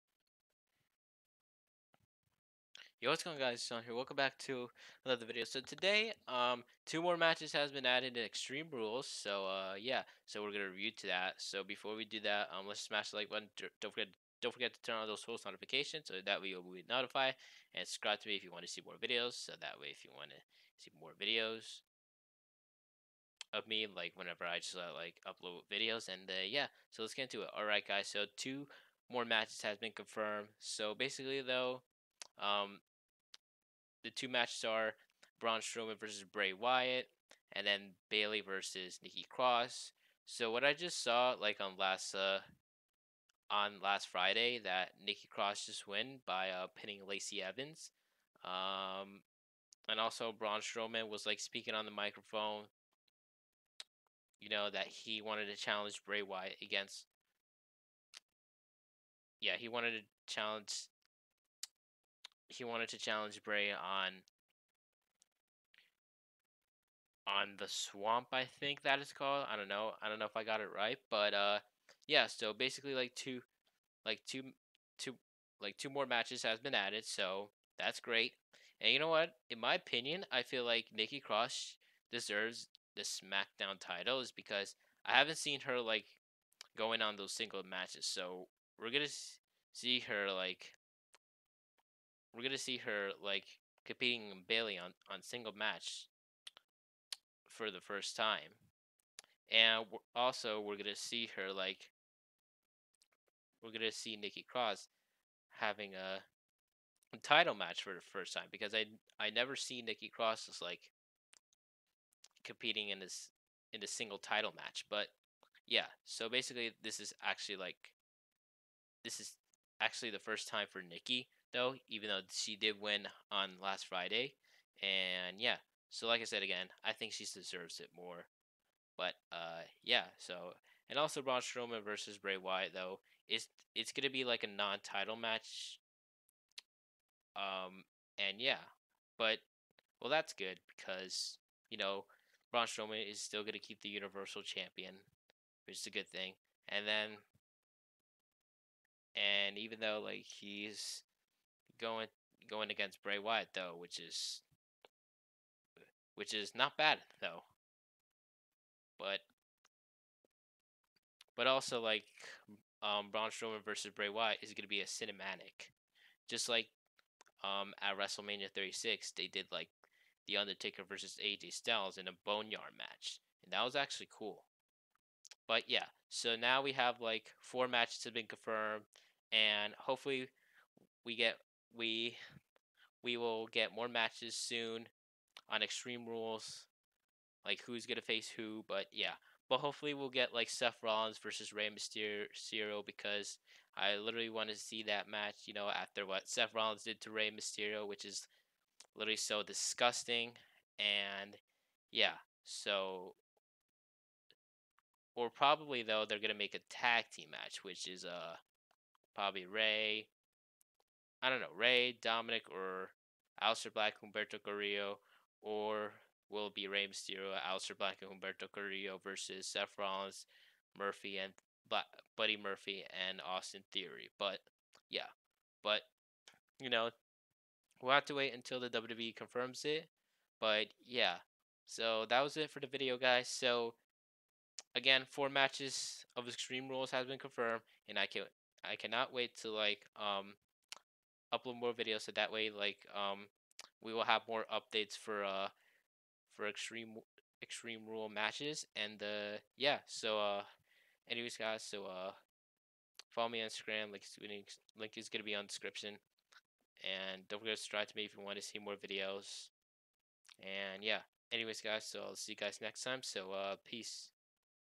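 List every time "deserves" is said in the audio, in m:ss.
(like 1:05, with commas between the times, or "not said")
1:22, 2:07.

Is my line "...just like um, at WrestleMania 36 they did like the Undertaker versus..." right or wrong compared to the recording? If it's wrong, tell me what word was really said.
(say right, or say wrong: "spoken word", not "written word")
right.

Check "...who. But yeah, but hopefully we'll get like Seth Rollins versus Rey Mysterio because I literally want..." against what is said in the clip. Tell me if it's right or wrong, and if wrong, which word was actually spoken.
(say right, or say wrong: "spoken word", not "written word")
right.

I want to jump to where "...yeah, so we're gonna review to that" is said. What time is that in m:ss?
0:09.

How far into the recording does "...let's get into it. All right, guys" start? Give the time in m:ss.
0:27.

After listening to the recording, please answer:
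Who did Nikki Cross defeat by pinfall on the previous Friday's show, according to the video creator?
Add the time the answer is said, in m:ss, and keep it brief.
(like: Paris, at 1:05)
Lacey Evans, at 0:47.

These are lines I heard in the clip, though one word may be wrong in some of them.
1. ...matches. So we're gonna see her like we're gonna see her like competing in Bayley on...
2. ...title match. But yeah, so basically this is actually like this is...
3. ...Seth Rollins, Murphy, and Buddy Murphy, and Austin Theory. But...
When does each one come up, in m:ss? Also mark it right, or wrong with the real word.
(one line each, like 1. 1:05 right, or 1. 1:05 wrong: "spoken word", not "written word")
1. 1:27 right
2. 1:54 right
3. 3:39 right.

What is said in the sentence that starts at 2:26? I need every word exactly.
And then, and even though like he's going going against Bray Wyatt though, which is which is not bad though.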